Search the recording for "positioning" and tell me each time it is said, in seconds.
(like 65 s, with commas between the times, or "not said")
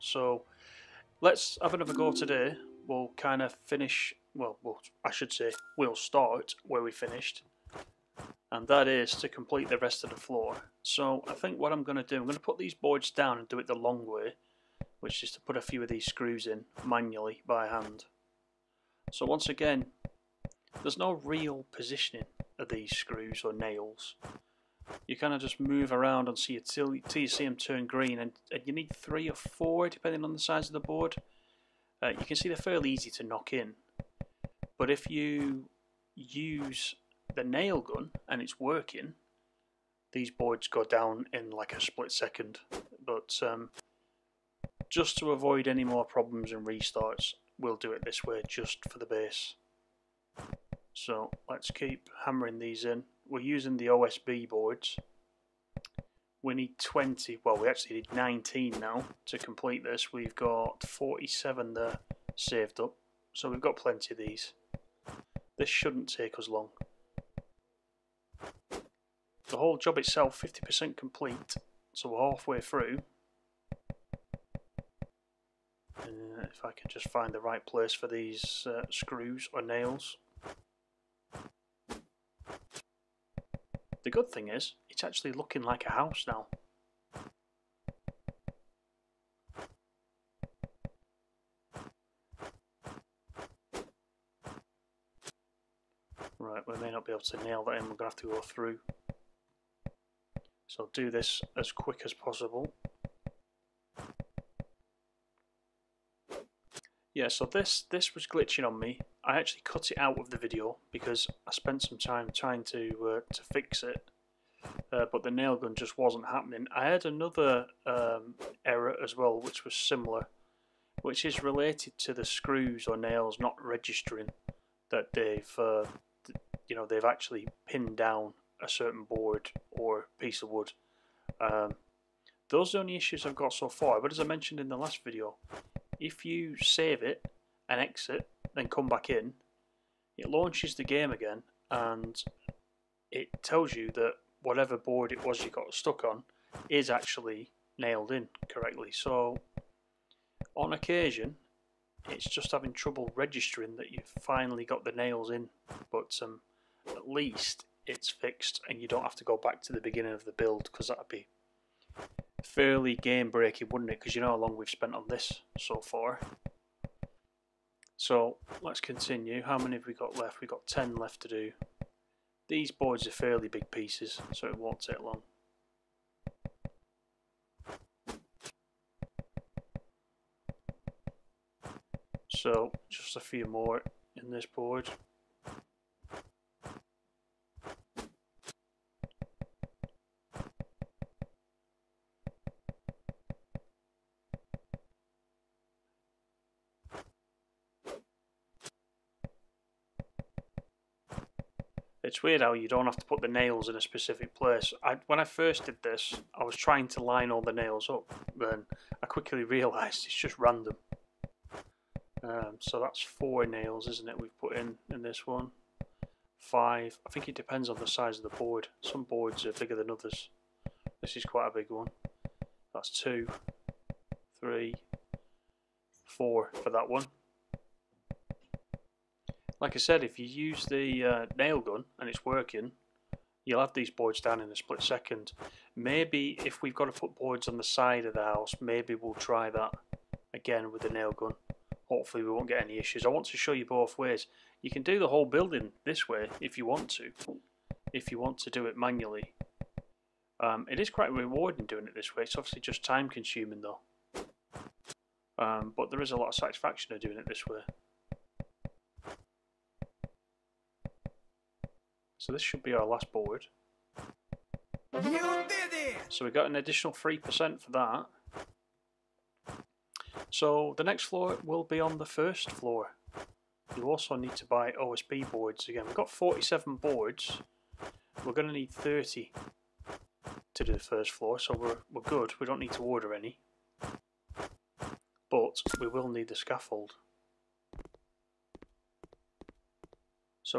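21 s.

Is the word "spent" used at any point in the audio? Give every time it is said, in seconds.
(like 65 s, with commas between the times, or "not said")
111 s, 164 s.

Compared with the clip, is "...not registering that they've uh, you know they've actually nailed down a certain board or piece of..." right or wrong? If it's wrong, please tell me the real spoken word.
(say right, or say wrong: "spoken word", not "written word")
wrong: "pinned", not "nailed".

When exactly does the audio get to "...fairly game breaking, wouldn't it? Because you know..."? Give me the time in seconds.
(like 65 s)
162 s.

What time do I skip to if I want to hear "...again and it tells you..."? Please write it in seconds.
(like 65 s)
141 s.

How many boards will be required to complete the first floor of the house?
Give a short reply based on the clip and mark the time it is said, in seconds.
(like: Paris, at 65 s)
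30, at 278 s.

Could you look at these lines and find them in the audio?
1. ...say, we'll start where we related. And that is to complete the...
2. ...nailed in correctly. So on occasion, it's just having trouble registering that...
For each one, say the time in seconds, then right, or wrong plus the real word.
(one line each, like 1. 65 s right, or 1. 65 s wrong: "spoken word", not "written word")
1. 5 s wrong: "finished", not "related"
2. 147 s right.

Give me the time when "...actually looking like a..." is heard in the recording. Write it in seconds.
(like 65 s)
85 s.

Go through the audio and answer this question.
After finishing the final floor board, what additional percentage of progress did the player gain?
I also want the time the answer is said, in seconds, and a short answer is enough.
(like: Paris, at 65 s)
3%, at 266 s.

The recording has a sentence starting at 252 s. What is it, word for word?
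It's obviously just time consuming though.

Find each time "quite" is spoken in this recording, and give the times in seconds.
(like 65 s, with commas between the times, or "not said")
221 s, 250 s.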